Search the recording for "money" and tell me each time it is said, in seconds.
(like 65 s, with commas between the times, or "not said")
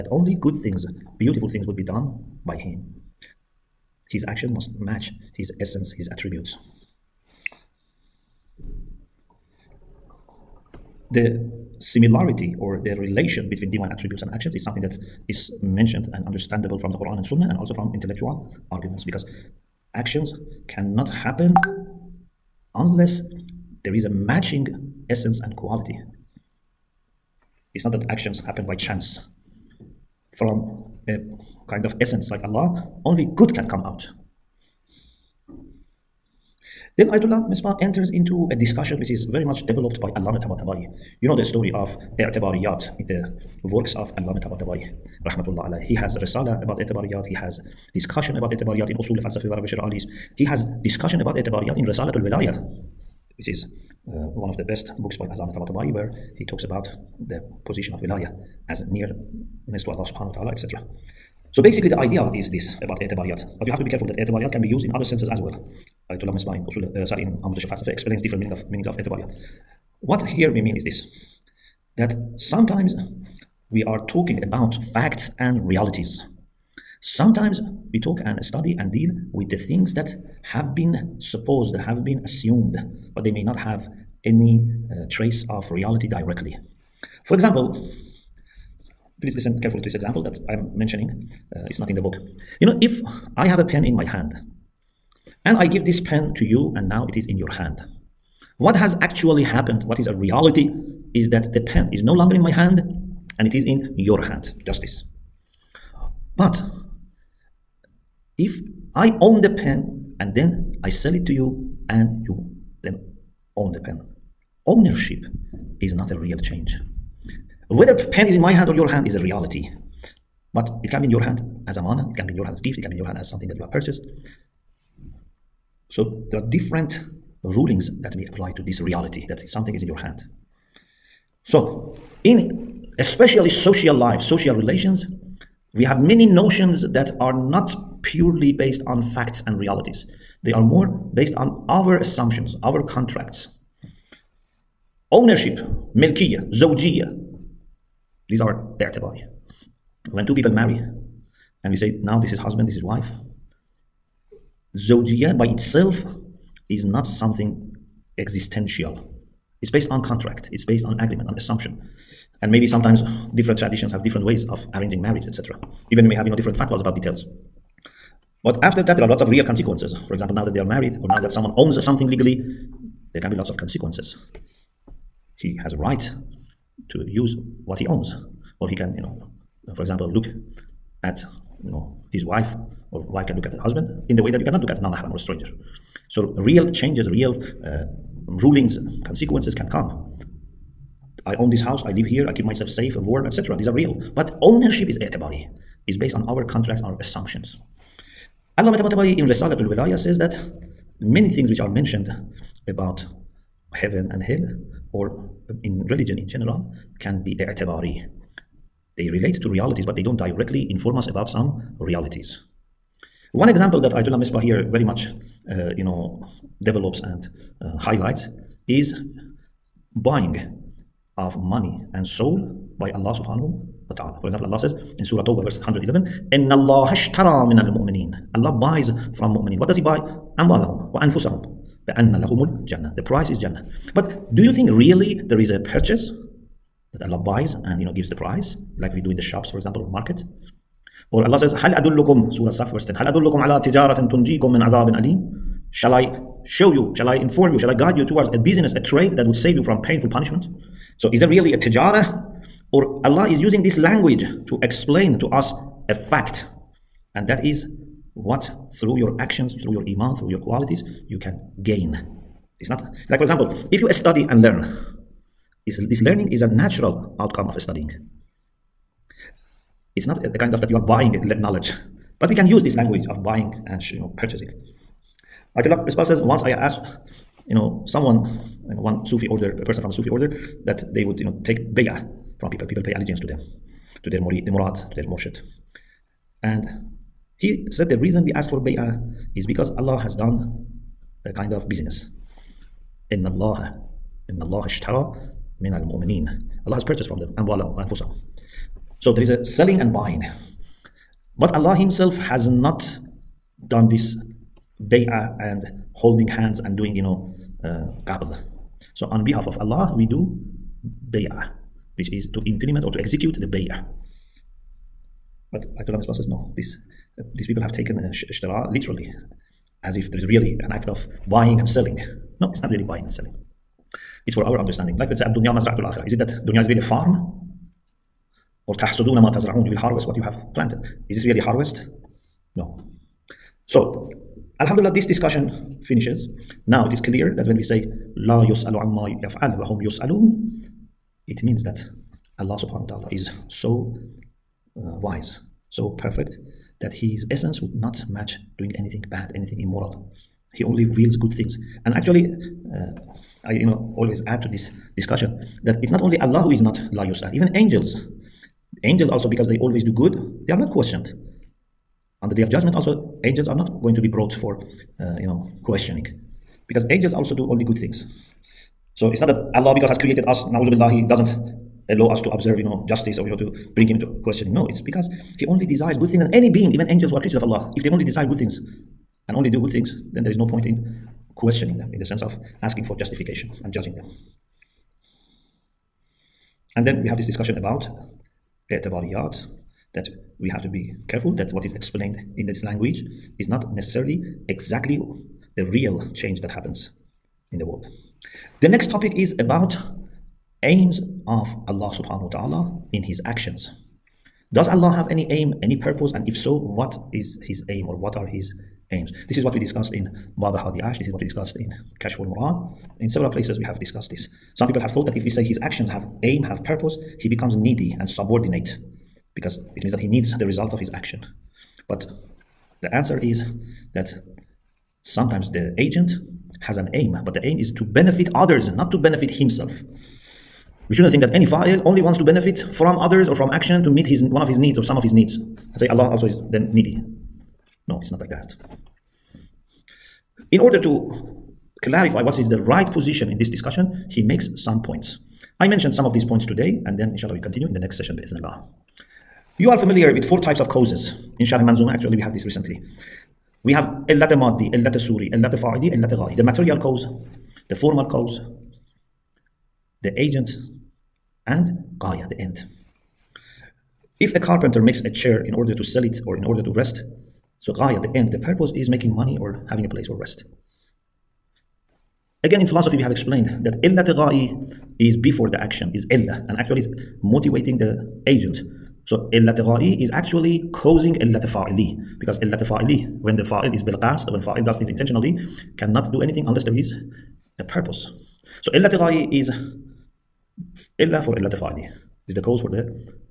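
221 s, 469 s.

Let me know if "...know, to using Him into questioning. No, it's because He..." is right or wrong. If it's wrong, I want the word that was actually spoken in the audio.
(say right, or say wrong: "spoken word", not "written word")
wrong: "bring", not "using".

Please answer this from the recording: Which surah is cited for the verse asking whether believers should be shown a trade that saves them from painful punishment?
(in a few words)
Surah Saf.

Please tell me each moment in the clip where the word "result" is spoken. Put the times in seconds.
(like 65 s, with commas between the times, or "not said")
420 s.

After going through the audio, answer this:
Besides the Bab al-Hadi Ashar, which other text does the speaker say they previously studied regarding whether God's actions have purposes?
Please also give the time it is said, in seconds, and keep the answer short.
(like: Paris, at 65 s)
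Kashful Murad, at 412 s.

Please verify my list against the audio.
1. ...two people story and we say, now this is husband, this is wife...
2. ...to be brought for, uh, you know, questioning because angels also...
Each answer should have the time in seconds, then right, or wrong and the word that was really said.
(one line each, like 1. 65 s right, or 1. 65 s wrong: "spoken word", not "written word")
1. 150 s wrong: "marry", not "story"
2. 363 s right.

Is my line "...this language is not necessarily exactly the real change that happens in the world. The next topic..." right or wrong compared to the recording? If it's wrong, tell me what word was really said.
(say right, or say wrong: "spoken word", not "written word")
right.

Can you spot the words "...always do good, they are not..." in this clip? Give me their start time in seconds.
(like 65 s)
359 s.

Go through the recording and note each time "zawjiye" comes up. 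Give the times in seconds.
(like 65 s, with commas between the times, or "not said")
146 s, 154 s.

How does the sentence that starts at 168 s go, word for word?
But after that, there are lots of real consequences.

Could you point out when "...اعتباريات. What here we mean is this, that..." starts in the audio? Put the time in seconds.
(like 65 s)
68 s.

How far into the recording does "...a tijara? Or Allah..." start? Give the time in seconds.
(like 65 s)
251 s.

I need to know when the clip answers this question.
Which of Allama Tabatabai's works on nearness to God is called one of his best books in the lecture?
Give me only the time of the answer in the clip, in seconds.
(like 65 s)
199 s.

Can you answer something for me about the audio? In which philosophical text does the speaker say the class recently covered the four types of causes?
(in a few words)
Sharh Manzuma.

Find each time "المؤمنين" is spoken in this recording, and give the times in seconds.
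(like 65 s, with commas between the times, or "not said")
227 s, 295 s.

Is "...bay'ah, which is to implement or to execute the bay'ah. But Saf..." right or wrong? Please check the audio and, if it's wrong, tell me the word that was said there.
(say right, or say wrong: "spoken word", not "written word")
wrong: "Ayatollah", not "Saf".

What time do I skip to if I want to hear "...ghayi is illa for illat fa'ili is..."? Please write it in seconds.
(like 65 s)
488 s.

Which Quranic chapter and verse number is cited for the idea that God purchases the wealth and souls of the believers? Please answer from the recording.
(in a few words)
Surah Tawbah 111.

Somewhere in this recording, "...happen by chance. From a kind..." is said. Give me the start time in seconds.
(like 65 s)
28 s.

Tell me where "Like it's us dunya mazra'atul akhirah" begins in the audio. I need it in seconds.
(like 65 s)
325 s.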